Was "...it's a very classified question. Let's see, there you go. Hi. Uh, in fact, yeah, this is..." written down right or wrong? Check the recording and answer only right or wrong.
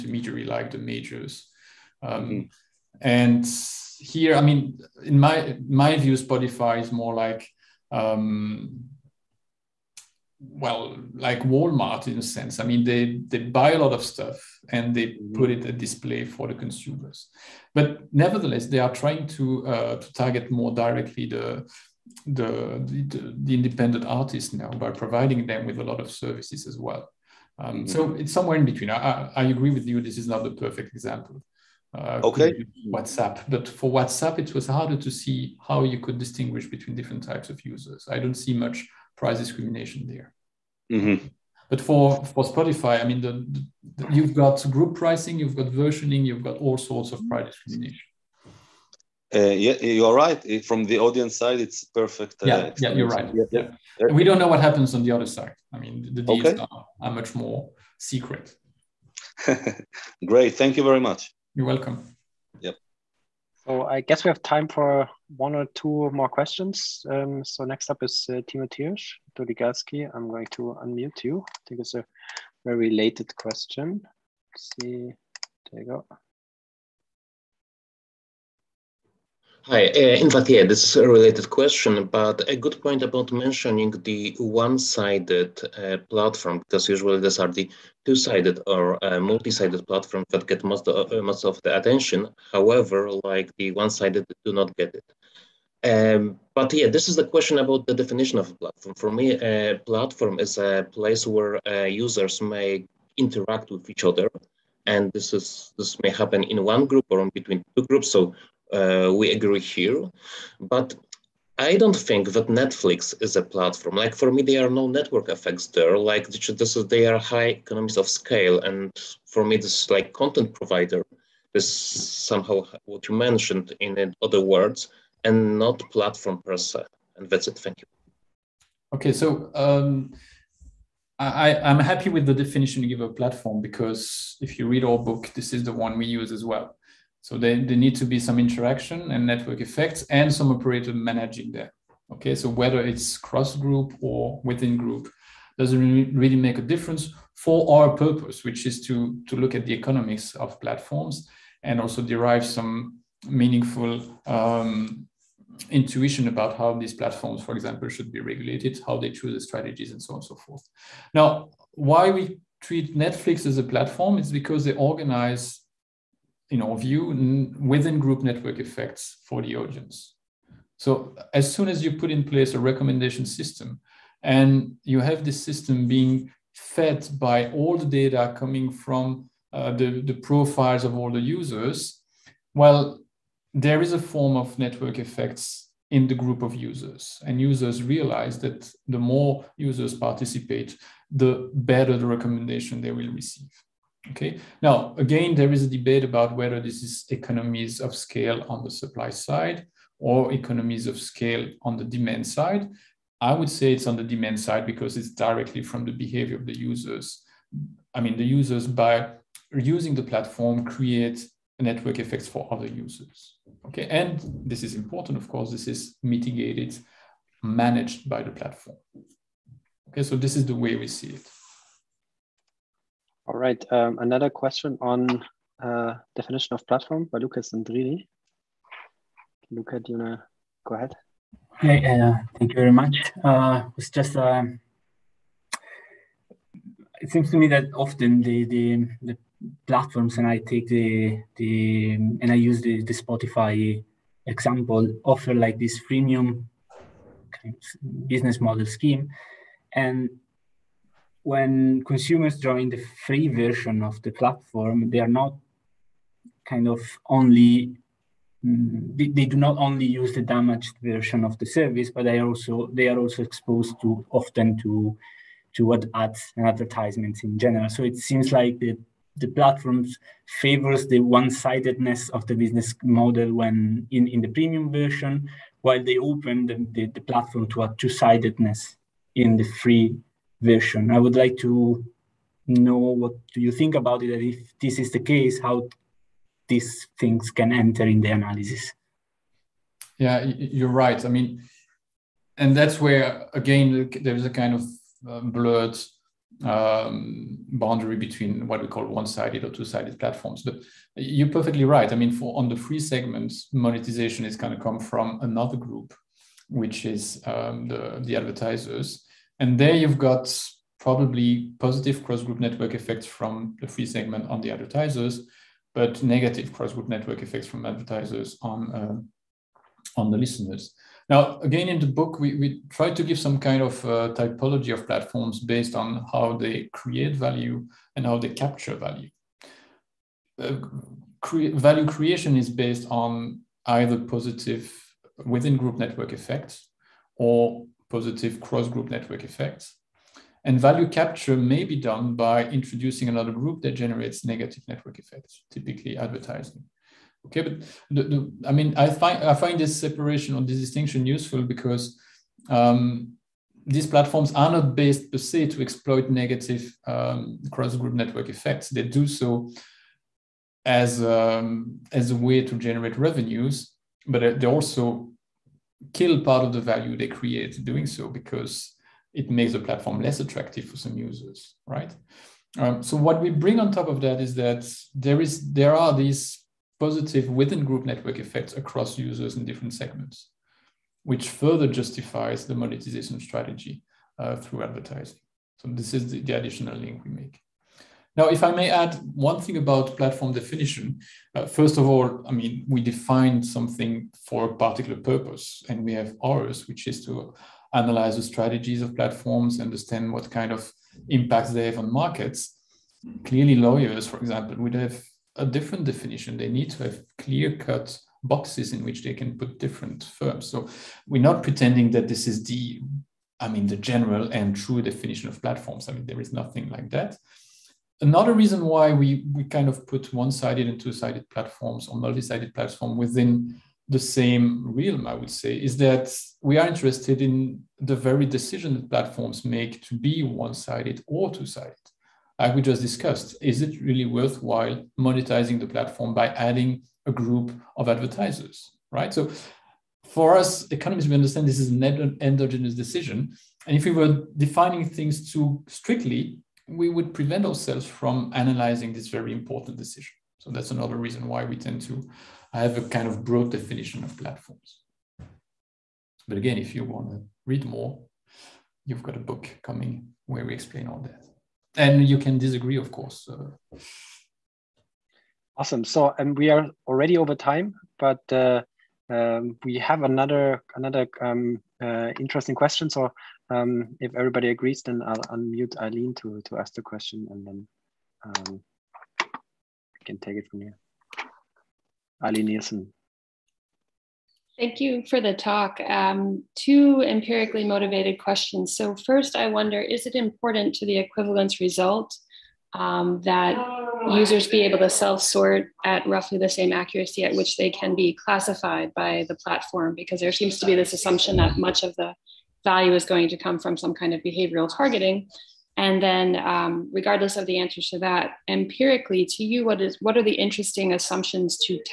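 wrong.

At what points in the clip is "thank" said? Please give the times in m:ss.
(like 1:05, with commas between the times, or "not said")
1:00, 2:07, 3:52, 8:04.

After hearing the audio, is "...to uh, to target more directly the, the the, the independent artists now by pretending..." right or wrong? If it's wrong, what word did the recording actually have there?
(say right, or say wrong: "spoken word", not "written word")
wrong: "providing", not "pretending".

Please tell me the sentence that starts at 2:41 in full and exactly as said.
Now, why we treat Netflix as a platform is because they organize in our view, within group network effects for the audience.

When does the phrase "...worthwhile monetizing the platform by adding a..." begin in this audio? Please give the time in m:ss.
7:14.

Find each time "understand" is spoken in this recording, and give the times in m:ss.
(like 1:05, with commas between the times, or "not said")
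6:39, 7:21.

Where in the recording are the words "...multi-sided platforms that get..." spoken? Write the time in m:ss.
1:29.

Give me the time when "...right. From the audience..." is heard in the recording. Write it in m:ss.
0:50.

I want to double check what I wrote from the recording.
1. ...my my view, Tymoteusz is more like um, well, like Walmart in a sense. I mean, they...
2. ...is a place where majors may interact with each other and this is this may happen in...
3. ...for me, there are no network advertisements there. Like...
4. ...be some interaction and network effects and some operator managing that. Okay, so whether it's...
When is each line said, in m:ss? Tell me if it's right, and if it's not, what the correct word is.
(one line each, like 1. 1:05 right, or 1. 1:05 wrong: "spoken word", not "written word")
1. 0:05 wrong: "Spotify", not "Tymoteusz"
2. 1:40 wrong: "users", not "majors"
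3. 1:54 wrong: "effects", not "advertisements"
4. 2:18 right.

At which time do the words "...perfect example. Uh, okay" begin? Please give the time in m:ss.
0:30.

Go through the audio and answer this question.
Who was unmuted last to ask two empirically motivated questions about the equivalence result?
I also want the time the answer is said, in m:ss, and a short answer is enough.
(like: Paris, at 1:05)
Aileen Nielsen, at 8:02.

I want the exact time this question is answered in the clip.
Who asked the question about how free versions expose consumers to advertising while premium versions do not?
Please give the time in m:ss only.
3:47.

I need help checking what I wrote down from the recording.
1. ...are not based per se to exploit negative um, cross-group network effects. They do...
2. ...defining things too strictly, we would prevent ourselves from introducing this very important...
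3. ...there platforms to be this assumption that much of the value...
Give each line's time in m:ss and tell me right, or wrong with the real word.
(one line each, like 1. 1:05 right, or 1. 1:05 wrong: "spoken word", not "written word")
1. 5:54 right
2. 7:24 wrong: "analyzing", not "introducing"
3. 8:20 wrong: "seems", not "platforms".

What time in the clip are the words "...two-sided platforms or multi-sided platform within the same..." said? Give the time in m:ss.
7:00.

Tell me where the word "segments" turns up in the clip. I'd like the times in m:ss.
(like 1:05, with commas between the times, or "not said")
5:02, 5:13, 6:19.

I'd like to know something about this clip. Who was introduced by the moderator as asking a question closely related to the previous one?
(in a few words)
Tymoteusz Doligalski.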